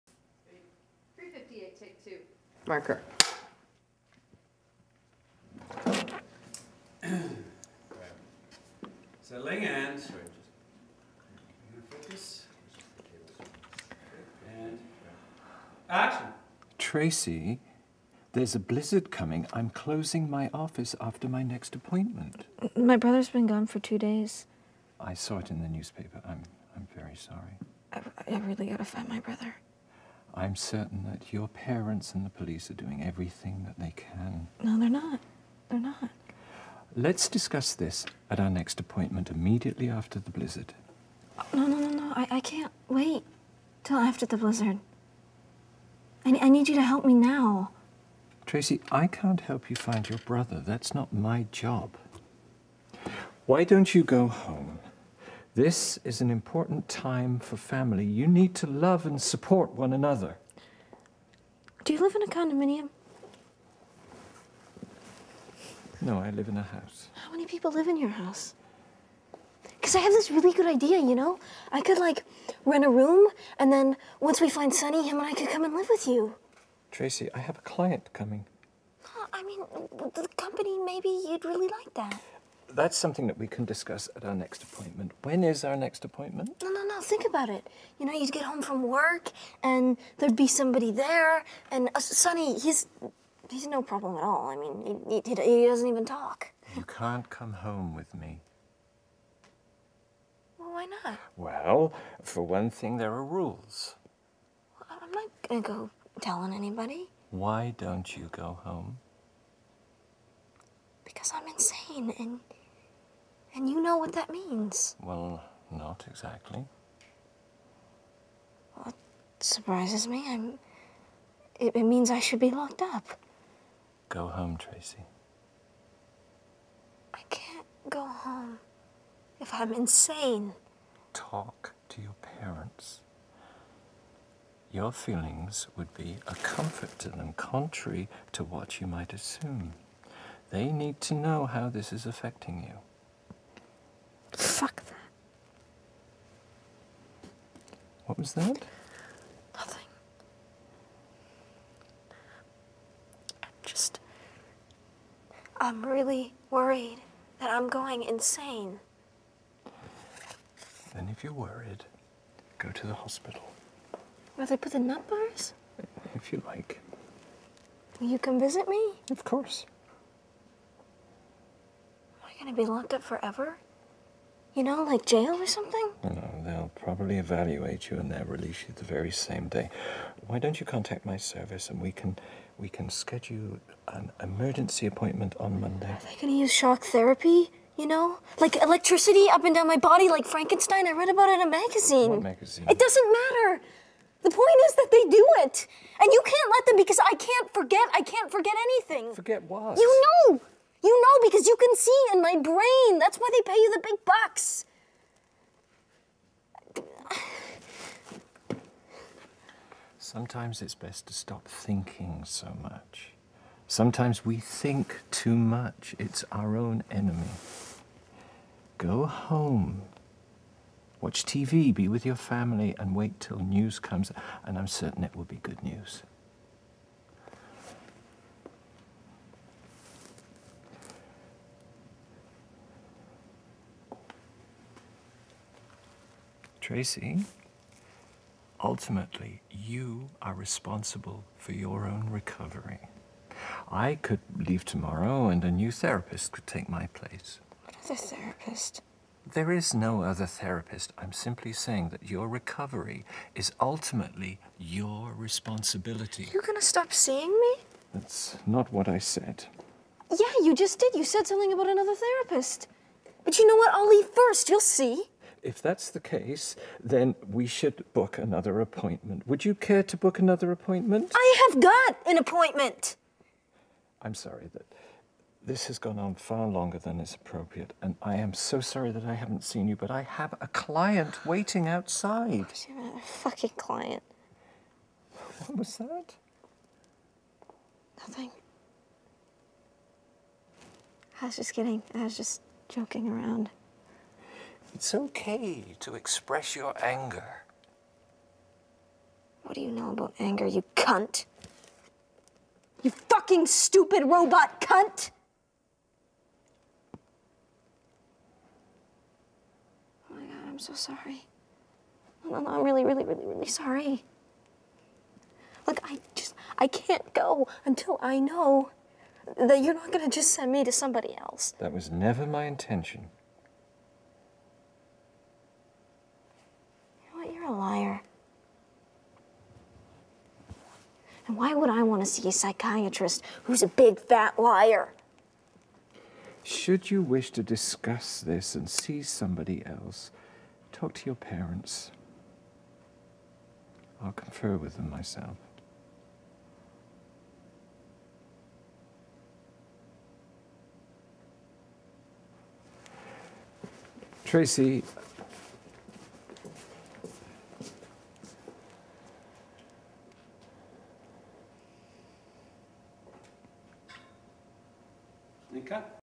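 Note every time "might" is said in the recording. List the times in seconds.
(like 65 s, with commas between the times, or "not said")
138 s.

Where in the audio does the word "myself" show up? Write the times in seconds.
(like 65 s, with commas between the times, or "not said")
344 s.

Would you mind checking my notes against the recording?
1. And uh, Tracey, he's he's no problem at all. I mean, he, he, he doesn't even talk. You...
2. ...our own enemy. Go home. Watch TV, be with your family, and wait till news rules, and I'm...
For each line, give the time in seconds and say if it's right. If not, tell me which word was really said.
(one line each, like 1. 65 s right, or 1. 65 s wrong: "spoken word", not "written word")
1. 91 s wrong: "Sonny", not "Tracey"
2. 216 s wrong: "comes", not "rules".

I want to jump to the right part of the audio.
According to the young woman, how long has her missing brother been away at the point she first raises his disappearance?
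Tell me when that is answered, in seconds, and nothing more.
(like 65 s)
23 s.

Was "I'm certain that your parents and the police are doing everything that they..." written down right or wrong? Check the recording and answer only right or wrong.
right.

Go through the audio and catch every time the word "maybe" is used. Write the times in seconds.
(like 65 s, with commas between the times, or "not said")
80 s.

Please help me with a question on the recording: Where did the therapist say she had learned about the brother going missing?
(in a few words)
The newspaper.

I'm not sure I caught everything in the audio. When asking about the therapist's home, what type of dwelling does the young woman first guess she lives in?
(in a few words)
A condominium.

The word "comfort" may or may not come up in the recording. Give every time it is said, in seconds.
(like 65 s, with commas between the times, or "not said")
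136 s.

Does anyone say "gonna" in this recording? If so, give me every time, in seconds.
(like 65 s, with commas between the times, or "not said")
105 s, 186 s, 256 s, 319 s.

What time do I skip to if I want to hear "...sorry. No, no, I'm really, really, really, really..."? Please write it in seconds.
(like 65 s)
310 s.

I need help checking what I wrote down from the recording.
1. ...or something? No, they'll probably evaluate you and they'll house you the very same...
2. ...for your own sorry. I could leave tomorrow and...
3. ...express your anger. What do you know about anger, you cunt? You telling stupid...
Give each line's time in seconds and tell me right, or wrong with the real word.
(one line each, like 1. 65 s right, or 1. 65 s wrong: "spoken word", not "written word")
1. 175 s wrong: "release", not "house"
2. 241 s wrong: "recovery", not "sorry"
3. 295 s wrong: "fucking", not "telling".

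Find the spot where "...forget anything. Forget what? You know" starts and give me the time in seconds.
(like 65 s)
198 s.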